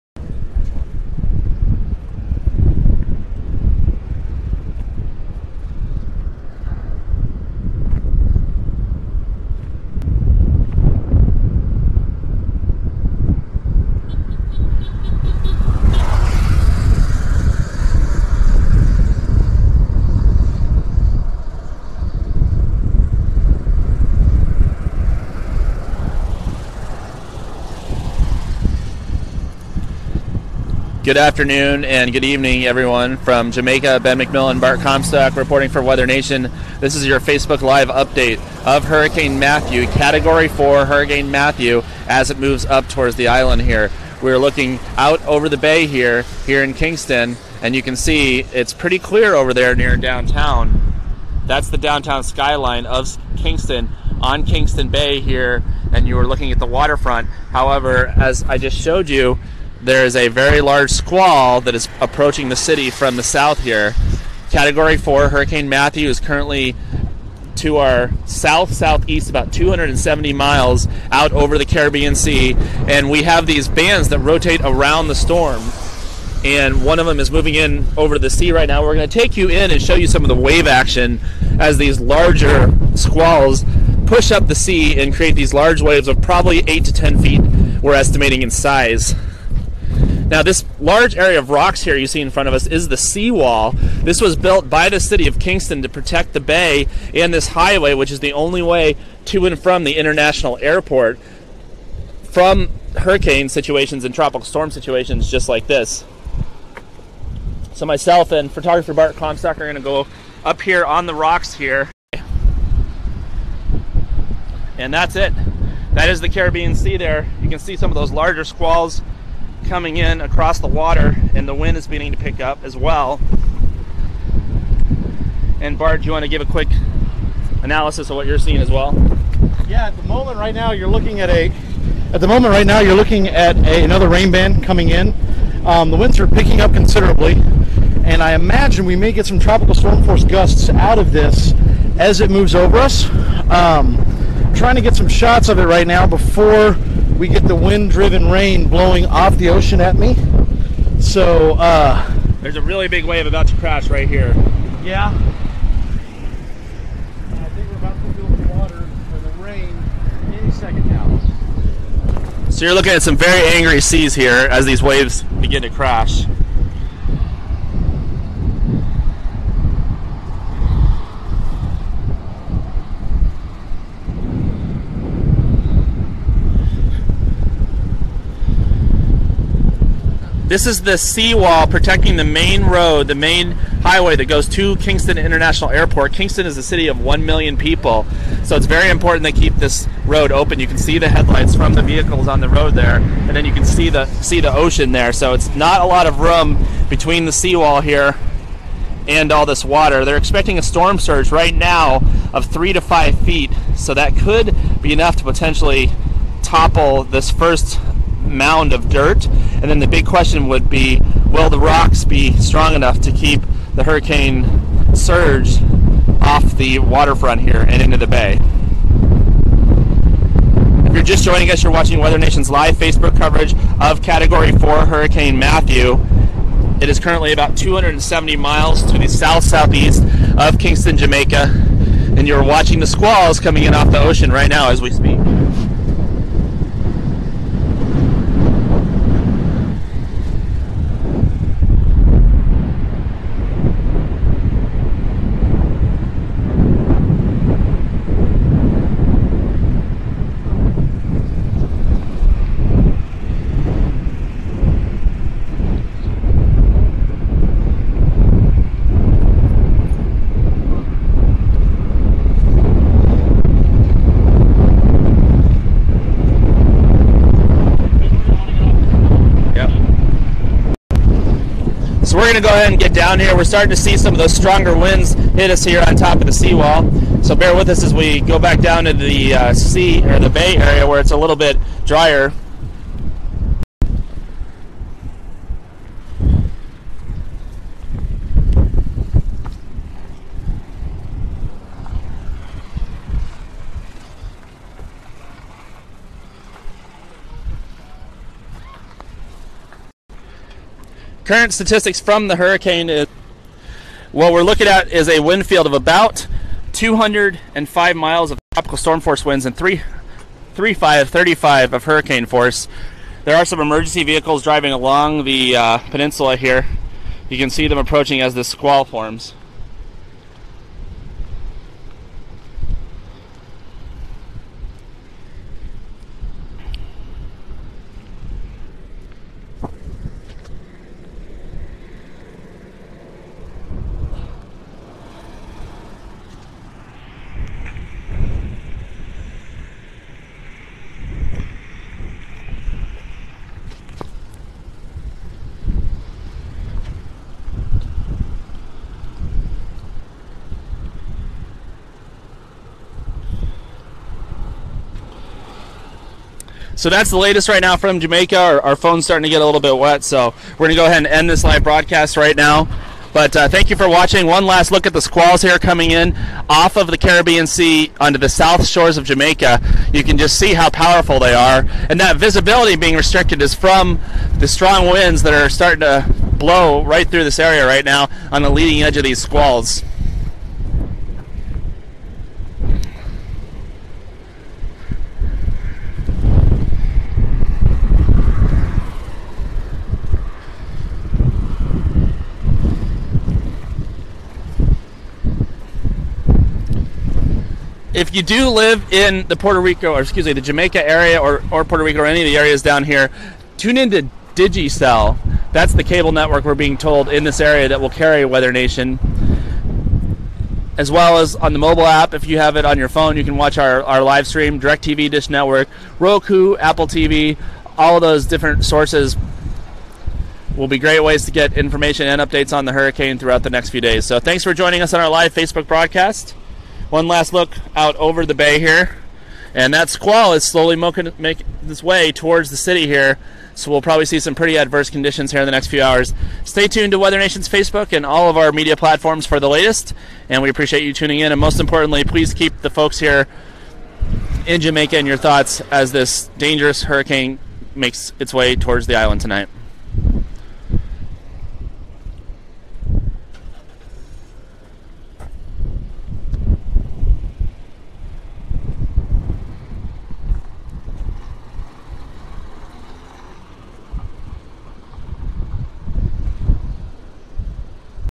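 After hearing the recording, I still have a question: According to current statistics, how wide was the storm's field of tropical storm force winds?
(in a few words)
205 miles.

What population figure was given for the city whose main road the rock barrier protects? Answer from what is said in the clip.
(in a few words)
1 million.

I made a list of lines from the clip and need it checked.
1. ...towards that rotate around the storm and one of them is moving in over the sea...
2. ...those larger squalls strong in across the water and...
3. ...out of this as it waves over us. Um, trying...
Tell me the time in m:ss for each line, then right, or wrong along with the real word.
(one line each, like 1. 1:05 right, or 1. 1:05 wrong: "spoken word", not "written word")
1. 1:13 wrong: "bands", not "towards"
2. 1:57 wrong: "coming", not "strong"
3. 2:20 wrong: "moves", not "waves".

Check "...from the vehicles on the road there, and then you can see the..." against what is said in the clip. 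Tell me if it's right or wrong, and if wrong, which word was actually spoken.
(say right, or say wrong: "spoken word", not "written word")
right.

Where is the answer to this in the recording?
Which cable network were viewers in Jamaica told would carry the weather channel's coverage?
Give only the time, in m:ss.
6:44.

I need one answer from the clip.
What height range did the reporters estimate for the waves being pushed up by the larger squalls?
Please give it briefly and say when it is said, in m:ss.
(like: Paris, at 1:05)
8 to 10 feet, at 1:26.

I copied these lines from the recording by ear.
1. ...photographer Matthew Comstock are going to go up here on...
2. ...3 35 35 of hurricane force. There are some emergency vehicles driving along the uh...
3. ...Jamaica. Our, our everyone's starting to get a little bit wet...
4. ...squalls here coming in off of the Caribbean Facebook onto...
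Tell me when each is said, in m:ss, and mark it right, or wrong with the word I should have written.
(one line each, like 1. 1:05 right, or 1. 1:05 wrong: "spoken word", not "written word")
1. 1:48 wrong: "Bart", not "Matthew"
2. 5:09 right
3. 5:57 wrong: "phone", not "everyone"
4. 6:05 wrong: "Sea", not "Facebook".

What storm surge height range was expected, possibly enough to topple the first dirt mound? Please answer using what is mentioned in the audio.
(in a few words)
3 to 5 feet.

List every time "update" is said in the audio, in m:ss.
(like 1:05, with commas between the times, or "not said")
0:37, 7:02.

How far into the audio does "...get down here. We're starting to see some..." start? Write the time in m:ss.
4:32.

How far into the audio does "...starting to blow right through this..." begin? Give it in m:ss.
6:15.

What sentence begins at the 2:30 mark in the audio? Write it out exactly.
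So, uh, There's a really big wave about to crash right here.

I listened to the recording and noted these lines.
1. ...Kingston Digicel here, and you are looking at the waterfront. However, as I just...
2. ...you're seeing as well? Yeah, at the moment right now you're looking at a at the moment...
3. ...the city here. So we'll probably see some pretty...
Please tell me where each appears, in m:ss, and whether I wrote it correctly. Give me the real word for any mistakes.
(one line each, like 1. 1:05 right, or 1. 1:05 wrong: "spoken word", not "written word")
1. 0:54 wrong: "Bay", not "Digicel"
2. 2:08 right
3. 7:12 right.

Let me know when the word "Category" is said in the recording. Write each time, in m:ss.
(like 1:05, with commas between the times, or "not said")
0:39, 1:04, 3:44.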